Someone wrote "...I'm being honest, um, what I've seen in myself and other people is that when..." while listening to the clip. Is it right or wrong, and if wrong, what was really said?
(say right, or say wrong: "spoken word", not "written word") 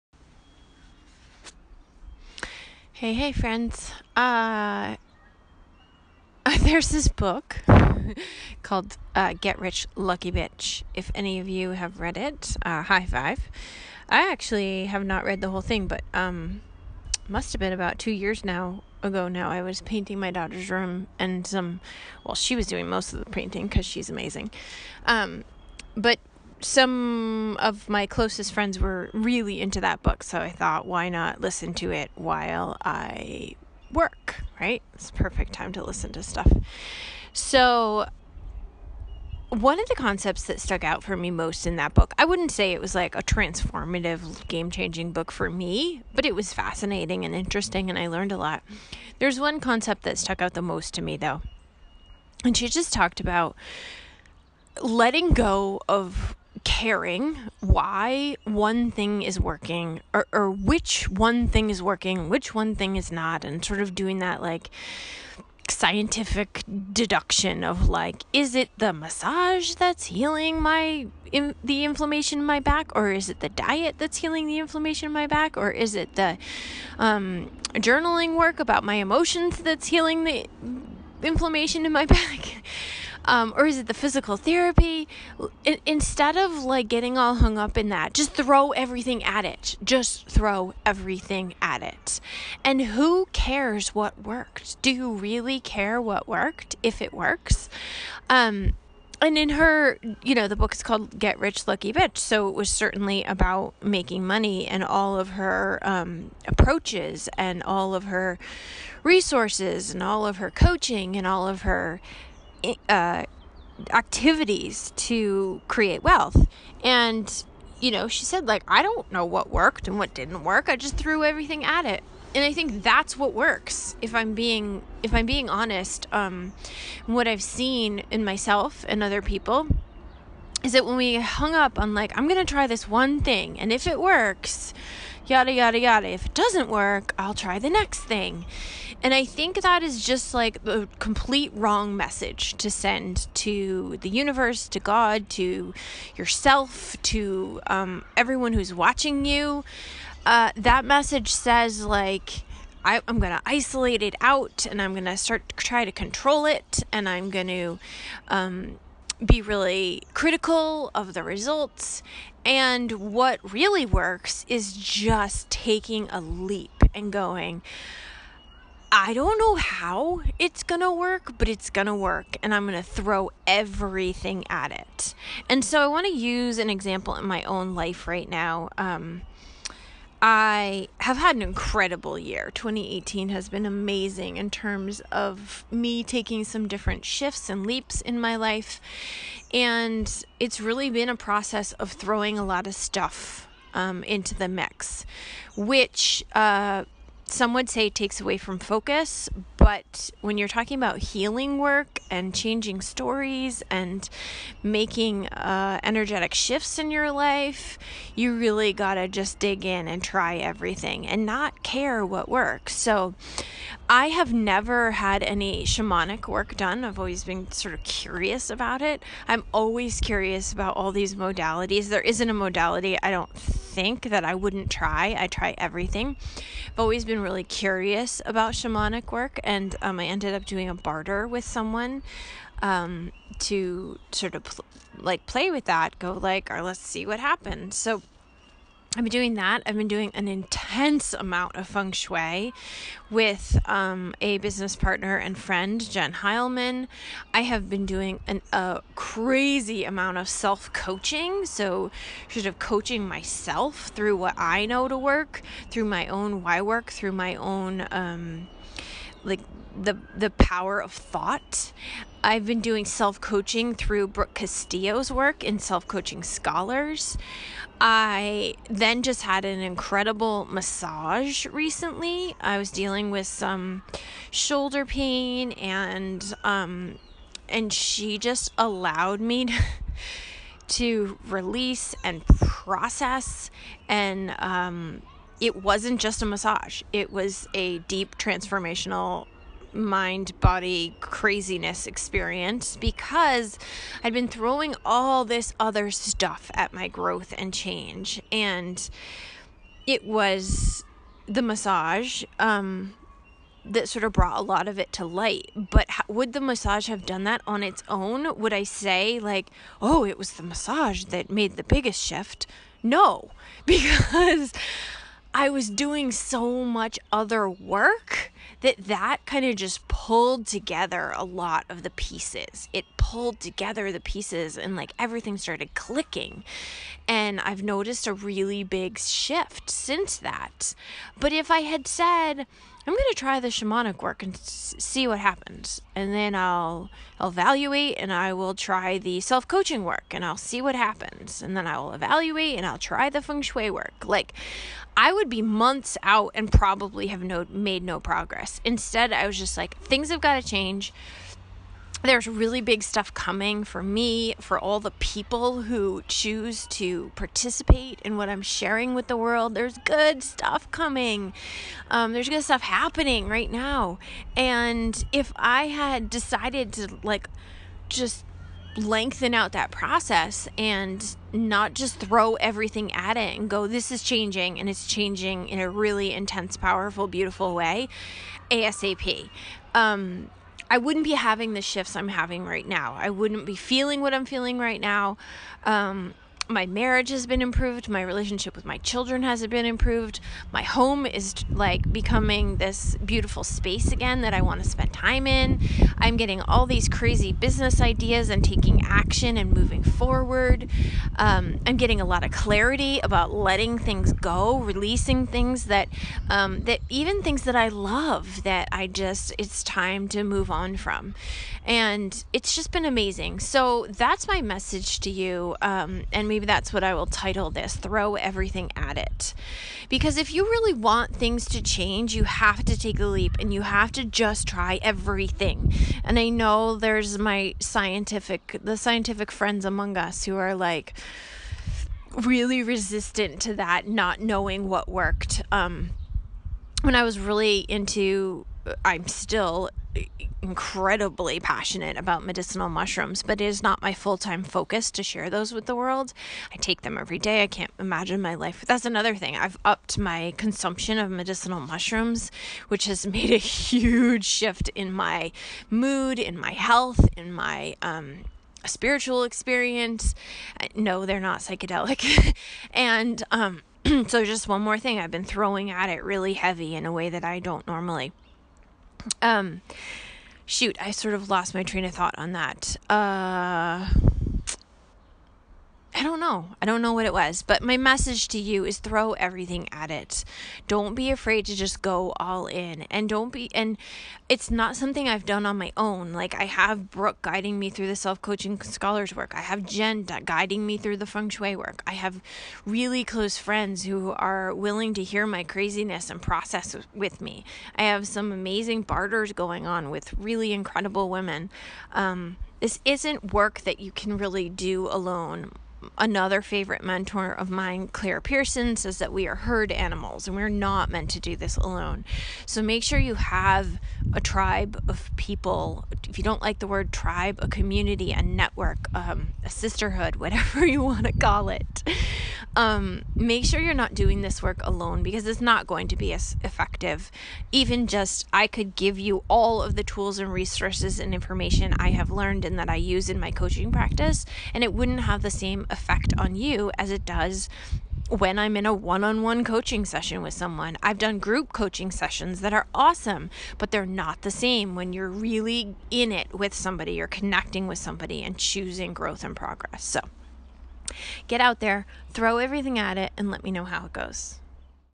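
right.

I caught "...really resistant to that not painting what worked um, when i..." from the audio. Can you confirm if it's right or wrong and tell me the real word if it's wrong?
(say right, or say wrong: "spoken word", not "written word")
wrong: "knowing", not "painting".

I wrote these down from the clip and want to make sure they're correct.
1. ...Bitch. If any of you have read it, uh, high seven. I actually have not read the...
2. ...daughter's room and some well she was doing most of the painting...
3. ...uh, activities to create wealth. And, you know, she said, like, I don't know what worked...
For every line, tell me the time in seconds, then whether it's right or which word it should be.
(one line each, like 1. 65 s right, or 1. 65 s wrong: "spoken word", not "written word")
1. 10 s wrong: "five", not "seven"
2. 20 s right
3. 112 s right.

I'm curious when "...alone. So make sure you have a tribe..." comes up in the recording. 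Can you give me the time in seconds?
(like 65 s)
511 s.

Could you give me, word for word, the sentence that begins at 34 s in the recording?
It's perfect time to listen to stuff.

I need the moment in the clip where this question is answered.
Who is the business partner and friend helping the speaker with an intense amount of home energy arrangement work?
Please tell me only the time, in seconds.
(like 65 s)
245 s.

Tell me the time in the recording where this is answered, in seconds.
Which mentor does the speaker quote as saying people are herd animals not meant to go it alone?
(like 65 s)
507 s.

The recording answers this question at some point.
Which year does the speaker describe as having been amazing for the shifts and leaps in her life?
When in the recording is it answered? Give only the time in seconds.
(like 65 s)
182 s.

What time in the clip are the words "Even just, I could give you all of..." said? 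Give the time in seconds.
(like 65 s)
527 s.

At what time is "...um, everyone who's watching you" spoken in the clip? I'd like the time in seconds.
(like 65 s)
147 s.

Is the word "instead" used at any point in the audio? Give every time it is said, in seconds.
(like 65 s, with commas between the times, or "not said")
85 s, 348 s.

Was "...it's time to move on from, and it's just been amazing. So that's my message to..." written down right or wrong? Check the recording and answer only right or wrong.
right.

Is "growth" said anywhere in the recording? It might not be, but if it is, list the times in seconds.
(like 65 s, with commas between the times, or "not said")
296 s, 548 s.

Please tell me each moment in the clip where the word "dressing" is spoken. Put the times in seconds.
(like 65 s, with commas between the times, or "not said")
not said.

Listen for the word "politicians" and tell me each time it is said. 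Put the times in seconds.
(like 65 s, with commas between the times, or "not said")
not said.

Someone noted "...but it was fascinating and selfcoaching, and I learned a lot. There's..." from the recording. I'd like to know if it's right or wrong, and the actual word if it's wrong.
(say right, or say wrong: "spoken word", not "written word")
wrong: "interesting", not "selfcoaching".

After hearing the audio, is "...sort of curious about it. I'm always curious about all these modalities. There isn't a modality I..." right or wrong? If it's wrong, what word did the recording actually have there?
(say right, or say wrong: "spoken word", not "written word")
right.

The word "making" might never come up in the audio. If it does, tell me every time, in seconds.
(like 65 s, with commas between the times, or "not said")
103 s, 204 s.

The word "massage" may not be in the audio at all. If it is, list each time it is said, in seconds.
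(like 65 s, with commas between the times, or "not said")
68 s, 270 s, 286 s, 301 s, 306 s, 310 s.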